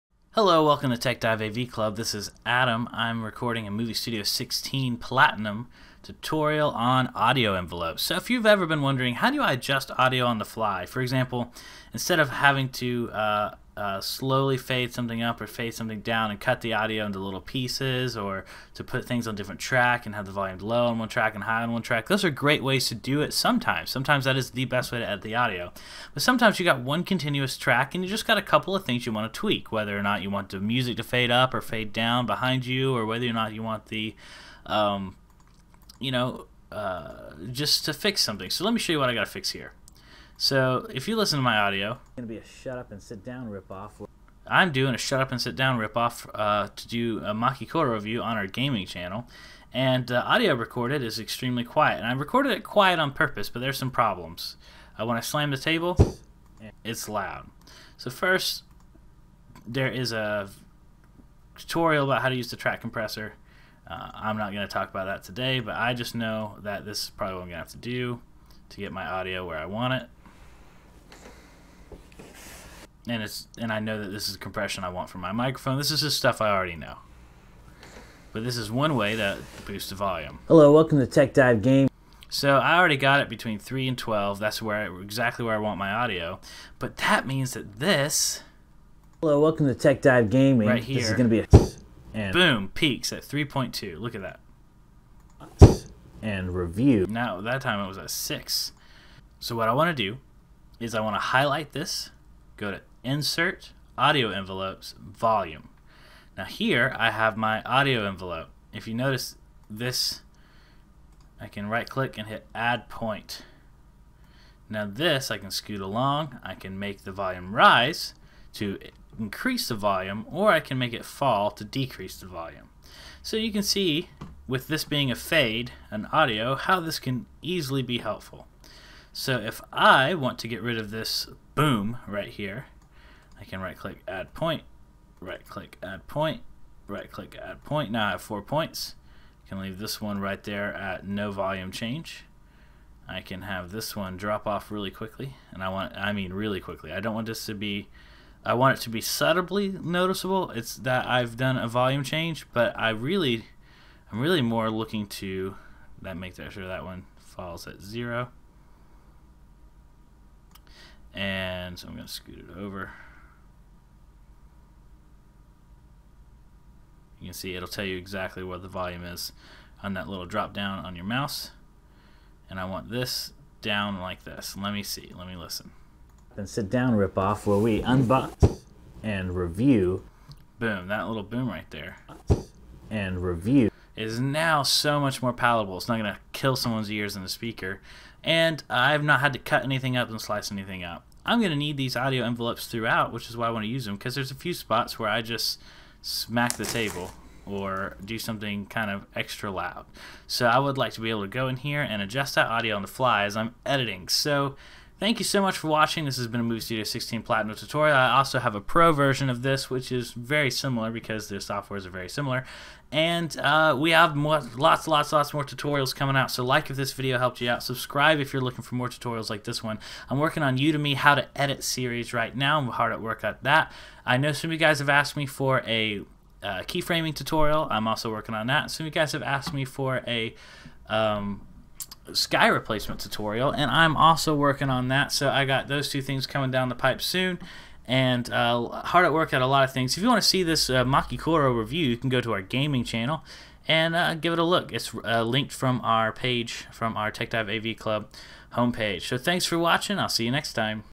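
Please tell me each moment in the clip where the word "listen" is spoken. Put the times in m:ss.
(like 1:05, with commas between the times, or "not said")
0:41, 2:55.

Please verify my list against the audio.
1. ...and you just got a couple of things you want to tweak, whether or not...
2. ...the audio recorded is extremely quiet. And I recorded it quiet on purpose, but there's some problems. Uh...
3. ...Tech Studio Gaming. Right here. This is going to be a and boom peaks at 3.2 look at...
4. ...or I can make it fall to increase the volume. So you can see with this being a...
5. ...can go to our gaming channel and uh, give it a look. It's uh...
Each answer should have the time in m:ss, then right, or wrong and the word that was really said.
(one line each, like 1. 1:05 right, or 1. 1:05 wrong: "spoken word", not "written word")
1. 0:27 right
2. 0:50 right
3. 1:29 wrong: "Dive", not "Studio"
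4. 2:00 wrong: "decrease", not "increase"
5. 4:01 right.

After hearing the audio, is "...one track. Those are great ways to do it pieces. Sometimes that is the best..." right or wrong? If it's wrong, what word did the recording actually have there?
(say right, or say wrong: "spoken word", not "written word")
wrong: "sometimes", not "pieces".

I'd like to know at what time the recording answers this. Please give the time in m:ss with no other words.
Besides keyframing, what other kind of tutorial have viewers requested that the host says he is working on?
3:52.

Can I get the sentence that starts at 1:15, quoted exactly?
This is just stuff I already know.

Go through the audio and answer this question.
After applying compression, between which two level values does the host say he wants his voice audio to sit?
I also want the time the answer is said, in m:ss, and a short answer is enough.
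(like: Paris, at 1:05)
3 and 12, at 1:23.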